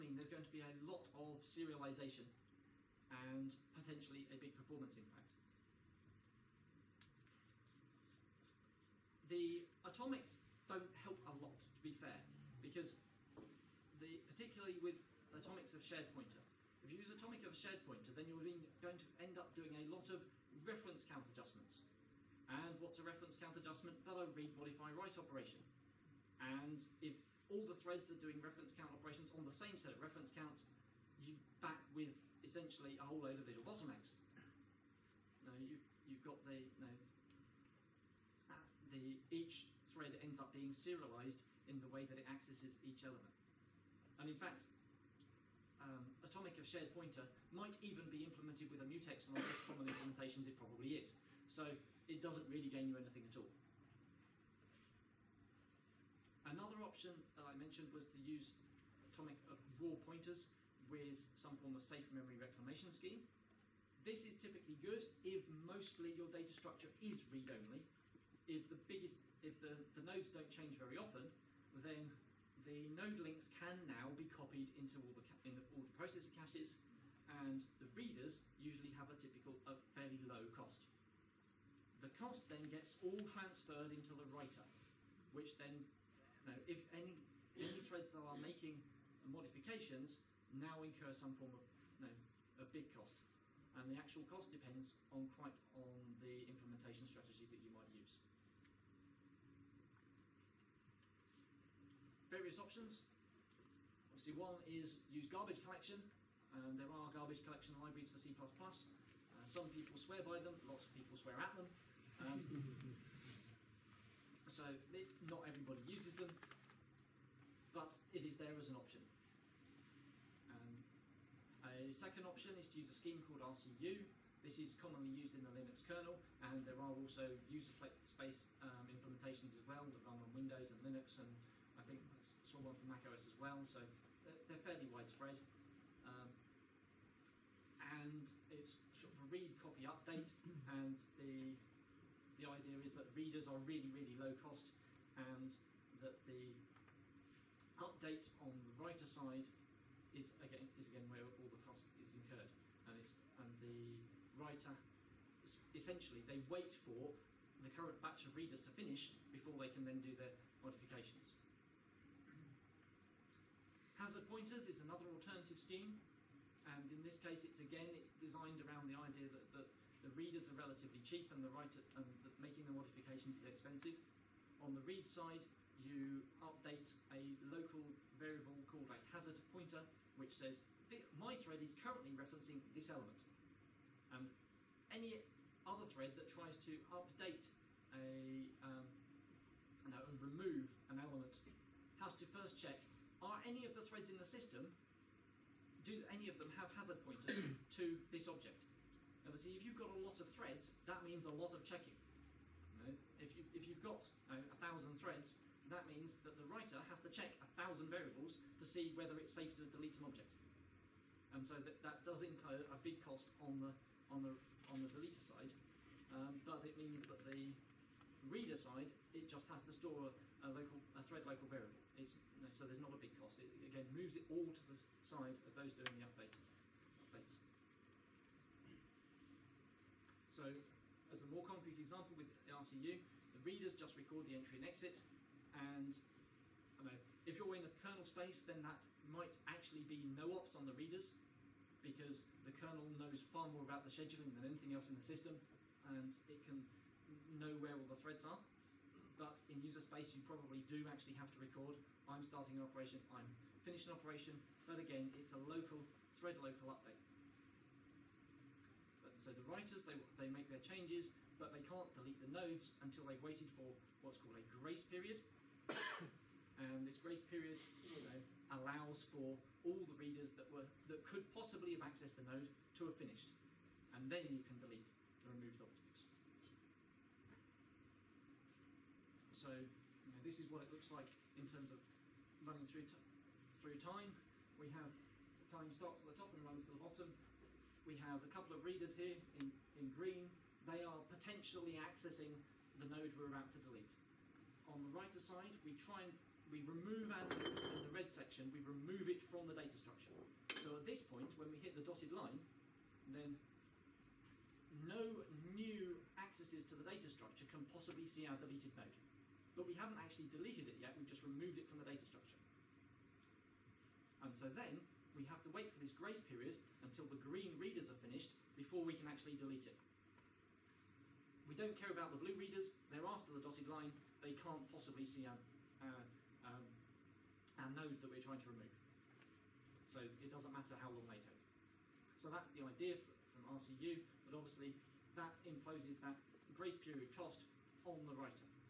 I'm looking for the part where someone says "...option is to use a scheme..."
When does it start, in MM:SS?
02:02.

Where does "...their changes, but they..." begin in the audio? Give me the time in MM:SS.
04:20.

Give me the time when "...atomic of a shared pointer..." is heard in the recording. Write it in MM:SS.
00:17.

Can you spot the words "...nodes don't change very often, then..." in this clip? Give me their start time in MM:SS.
01:10.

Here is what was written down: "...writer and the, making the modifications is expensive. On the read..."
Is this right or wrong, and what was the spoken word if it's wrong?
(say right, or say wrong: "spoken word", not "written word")
right.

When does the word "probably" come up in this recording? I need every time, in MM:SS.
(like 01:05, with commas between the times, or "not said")
00:50, 04:10.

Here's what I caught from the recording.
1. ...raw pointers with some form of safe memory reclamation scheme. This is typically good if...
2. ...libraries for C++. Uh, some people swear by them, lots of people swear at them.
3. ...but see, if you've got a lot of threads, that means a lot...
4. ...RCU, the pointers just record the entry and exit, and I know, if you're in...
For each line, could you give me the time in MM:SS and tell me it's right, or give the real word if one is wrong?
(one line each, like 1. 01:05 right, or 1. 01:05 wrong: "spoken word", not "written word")
1. 00:59 right
2. 01:47 right
3. 03:19 right
4. 03:52 wrong: "readers", not "pointers".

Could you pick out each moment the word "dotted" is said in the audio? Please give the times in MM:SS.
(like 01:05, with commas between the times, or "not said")
05:01, 05:23.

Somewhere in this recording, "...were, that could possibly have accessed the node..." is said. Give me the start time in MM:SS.
04:30.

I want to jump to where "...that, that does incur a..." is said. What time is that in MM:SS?
03:31.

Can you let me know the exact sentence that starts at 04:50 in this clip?
They are potentially accessing the node we're about to delete.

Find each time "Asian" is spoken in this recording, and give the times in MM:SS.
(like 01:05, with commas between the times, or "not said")
not said.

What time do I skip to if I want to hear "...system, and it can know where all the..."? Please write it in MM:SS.
04:05.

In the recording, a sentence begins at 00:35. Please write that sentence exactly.
Now you've, you've got the, you know, ah.